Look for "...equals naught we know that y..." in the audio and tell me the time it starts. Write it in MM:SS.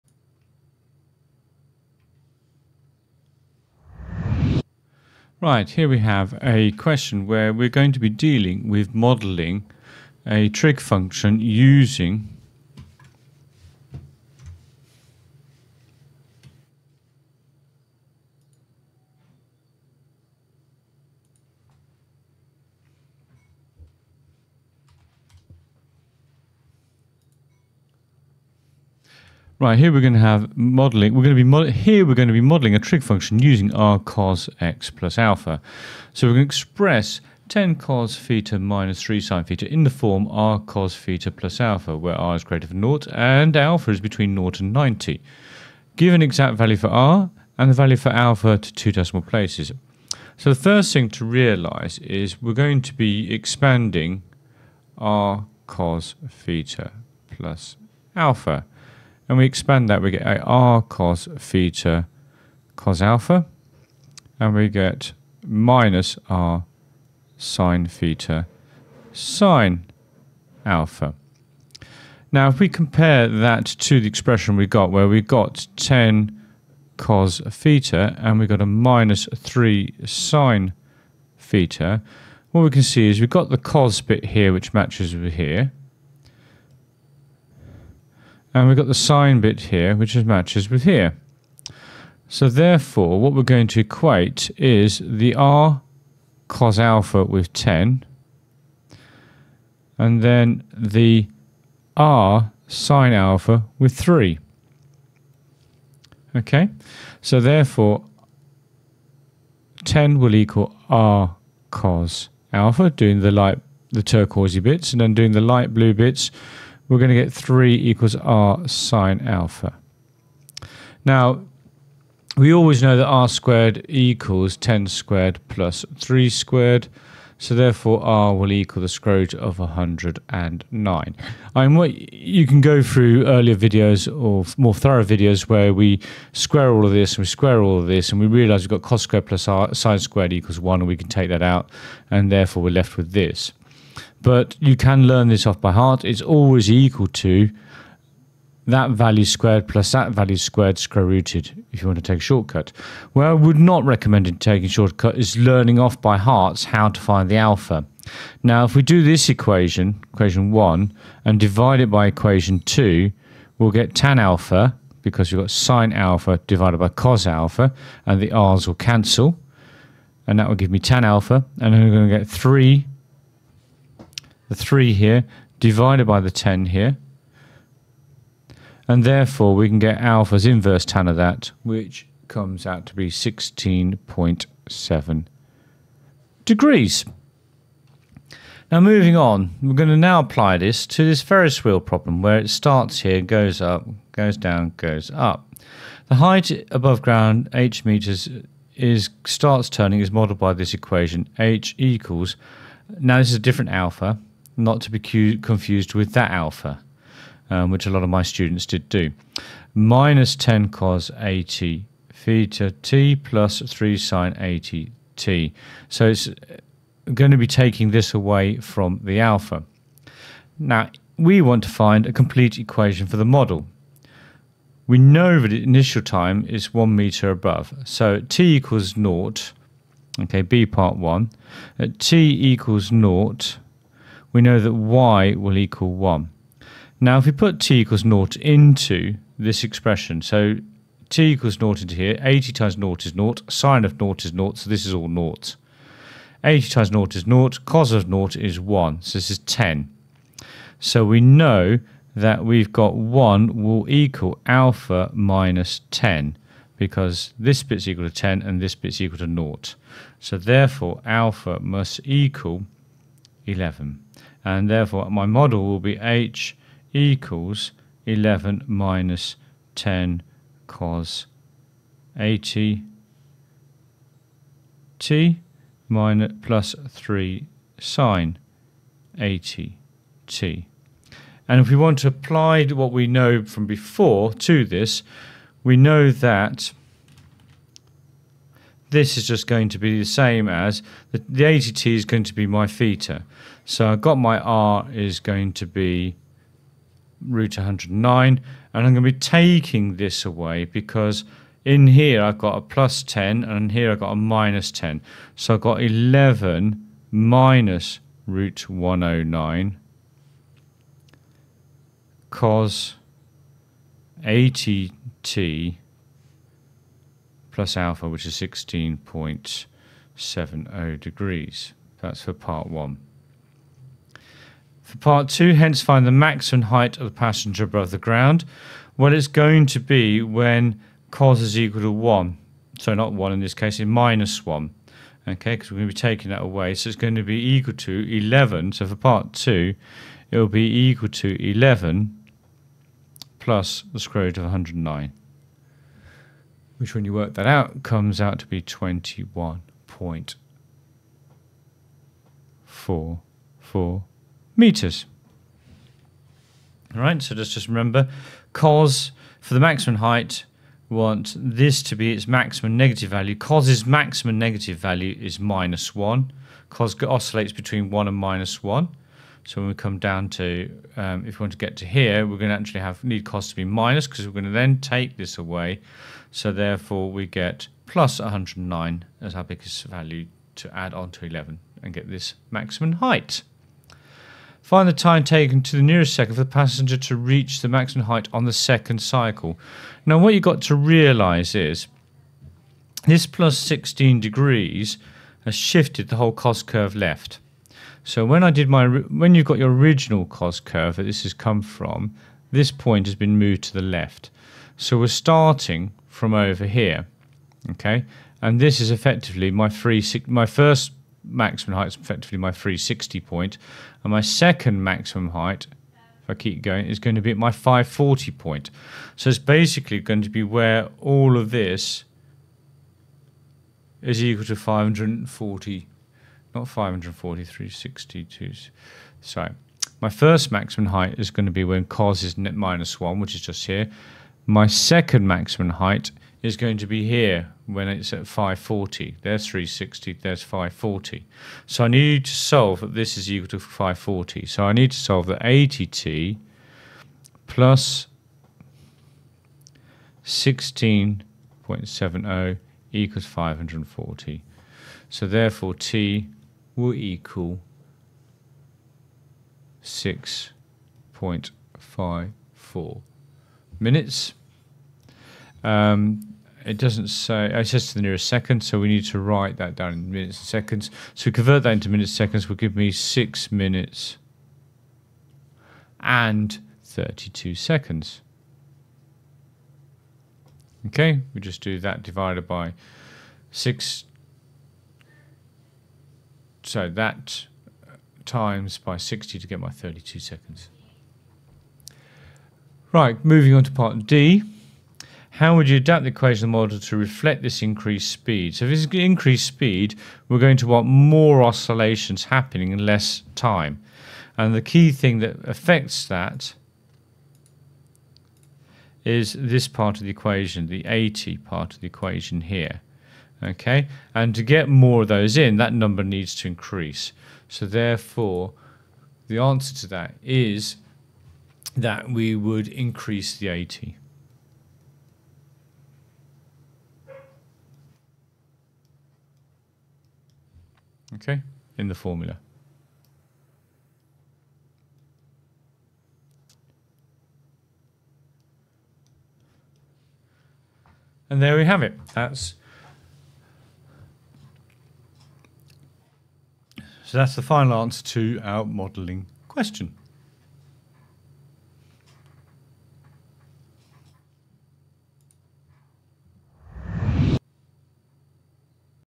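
03:52.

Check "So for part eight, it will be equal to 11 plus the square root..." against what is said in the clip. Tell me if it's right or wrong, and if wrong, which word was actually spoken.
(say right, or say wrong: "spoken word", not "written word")
wrong: "two", not "eight".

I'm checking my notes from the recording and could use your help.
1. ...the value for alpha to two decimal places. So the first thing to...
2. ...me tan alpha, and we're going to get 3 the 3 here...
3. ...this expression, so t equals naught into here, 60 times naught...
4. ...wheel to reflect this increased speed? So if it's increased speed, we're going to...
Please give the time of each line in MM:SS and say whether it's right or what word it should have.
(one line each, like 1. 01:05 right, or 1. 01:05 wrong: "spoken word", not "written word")
1. 00:47 right
2. 02:50 right
3. 03:59 wrong: "80", not "60"
4. 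08:16 wrong: "model", not "wheel".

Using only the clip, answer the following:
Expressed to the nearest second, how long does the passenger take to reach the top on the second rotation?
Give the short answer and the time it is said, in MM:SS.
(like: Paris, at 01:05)
6 minutes 32 seconds, at 07:52.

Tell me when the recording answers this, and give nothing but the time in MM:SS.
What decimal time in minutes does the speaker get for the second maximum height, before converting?
07:39.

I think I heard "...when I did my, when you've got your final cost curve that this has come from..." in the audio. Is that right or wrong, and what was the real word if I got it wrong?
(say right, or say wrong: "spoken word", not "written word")
wrong: "original", not "final".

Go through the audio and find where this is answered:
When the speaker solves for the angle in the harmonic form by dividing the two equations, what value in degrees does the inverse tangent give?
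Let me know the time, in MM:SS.
03:03.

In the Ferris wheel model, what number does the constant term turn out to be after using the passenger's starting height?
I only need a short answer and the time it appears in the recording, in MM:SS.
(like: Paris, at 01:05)
11, at 04:21.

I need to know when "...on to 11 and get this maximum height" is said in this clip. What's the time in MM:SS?
06:20.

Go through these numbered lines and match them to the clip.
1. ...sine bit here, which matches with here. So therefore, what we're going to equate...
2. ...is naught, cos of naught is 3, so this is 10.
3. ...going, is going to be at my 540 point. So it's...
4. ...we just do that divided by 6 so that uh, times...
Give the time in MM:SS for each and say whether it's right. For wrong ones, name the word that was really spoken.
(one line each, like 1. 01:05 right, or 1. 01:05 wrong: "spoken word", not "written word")
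1. 01:28 right
2. 04:07 wrong: "1", not "3"
3. 06:56 right
4. 08:01 right.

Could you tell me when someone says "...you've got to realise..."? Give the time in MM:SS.
06:30.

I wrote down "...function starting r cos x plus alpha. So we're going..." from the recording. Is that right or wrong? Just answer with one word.
wrong.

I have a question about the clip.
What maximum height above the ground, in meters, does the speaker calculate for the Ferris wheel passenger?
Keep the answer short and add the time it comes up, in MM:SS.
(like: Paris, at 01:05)
21.44 meters, at 05:48.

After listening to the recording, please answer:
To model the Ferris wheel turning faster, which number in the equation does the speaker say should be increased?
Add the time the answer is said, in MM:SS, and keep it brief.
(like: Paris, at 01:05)
80, at 08:42.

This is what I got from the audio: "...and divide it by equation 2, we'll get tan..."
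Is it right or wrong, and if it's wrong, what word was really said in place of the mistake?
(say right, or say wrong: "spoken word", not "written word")
right.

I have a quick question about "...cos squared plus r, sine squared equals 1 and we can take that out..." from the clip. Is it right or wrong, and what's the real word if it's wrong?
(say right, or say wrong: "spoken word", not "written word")
right.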